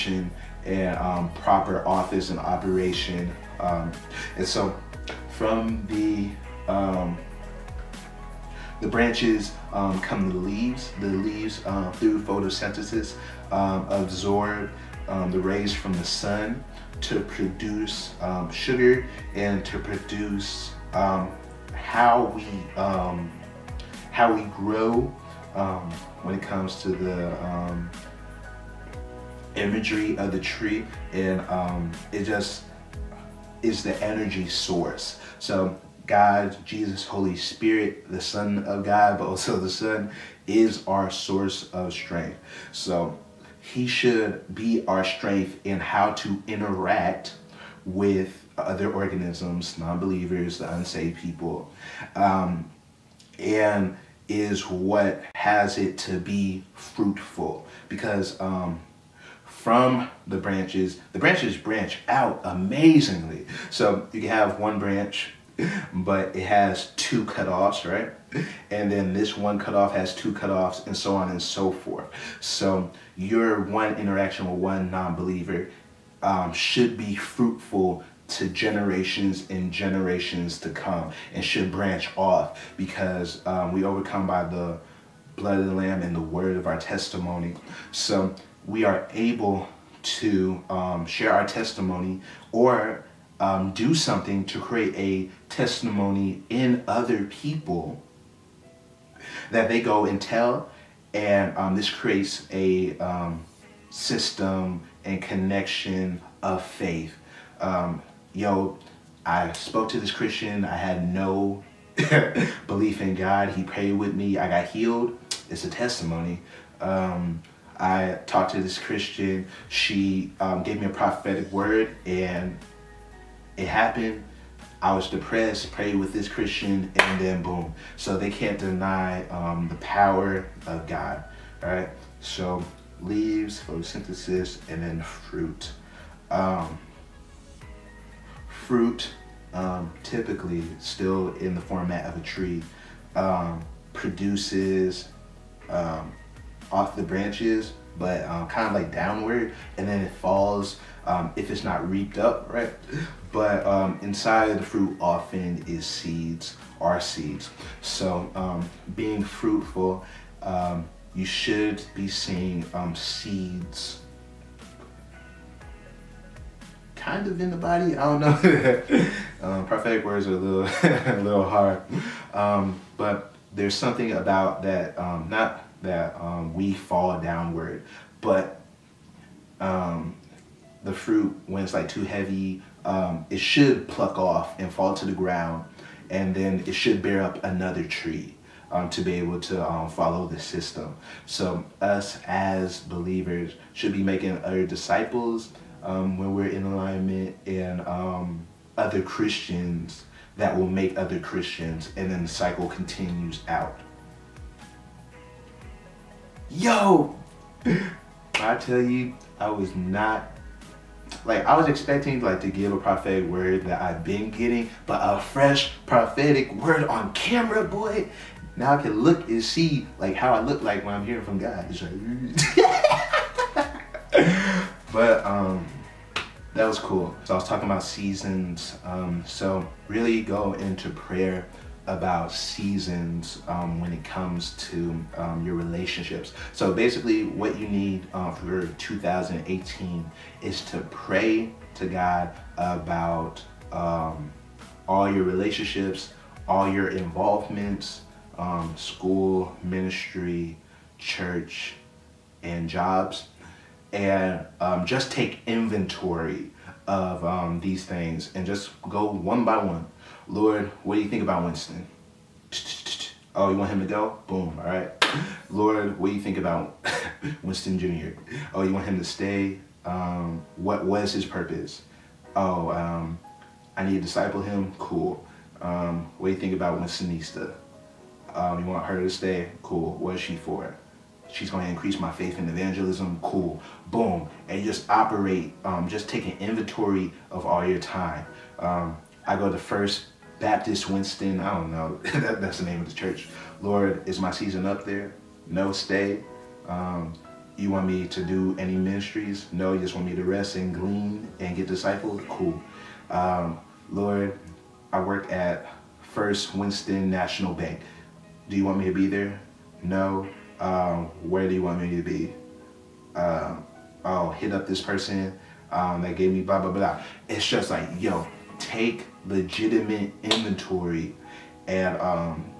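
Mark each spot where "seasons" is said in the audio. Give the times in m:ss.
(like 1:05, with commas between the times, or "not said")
3:47, 3:52, 4:54.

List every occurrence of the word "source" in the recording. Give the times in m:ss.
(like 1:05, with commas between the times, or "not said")
0:34, 0:41.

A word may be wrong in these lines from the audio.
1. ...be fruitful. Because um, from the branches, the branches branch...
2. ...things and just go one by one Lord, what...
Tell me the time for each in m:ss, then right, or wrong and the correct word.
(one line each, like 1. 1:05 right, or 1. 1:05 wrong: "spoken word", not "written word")
1. 0:56 right
2. 4:17 right.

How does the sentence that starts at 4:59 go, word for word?
No, you just want me to rest and glean and get discipled?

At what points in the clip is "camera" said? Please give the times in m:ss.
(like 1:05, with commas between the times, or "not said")
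3:37.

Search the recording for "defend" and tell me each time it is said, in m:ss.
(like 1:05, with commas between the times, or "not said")
not said.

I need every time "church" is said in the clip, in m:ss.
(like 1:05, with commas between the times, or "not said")
4:10, 4:52.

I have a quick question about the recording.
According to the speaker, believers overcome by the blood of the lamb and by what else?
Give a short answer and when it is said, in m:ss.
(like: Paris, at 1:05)
The word of our testimony, at 1:26.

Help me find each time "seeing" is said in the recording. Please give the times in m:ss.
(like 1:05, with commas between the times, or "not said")
2:42.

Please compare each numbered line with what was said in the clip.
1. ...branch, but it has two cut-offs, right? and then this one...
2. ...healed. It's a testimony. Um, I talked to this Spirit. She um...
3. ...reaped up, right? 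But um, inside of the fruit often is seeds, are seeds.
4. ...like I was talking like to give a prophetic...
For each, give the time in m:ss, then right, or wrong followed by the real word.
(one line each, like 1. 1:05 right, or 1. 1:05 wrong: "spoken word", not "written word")
1. 1:04 right
2. 1:54 wrong: "Christian", not "Spirit"
3. 2:31 right
4. 3:31 wrong: "expecting", not "talking".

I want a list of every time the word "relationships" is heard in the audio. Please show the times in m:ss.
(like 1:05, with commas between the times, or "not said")
3:55, 4:05.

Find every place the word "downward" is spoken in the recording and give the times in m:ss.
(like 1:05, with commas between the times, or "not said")
2:28, 2:57.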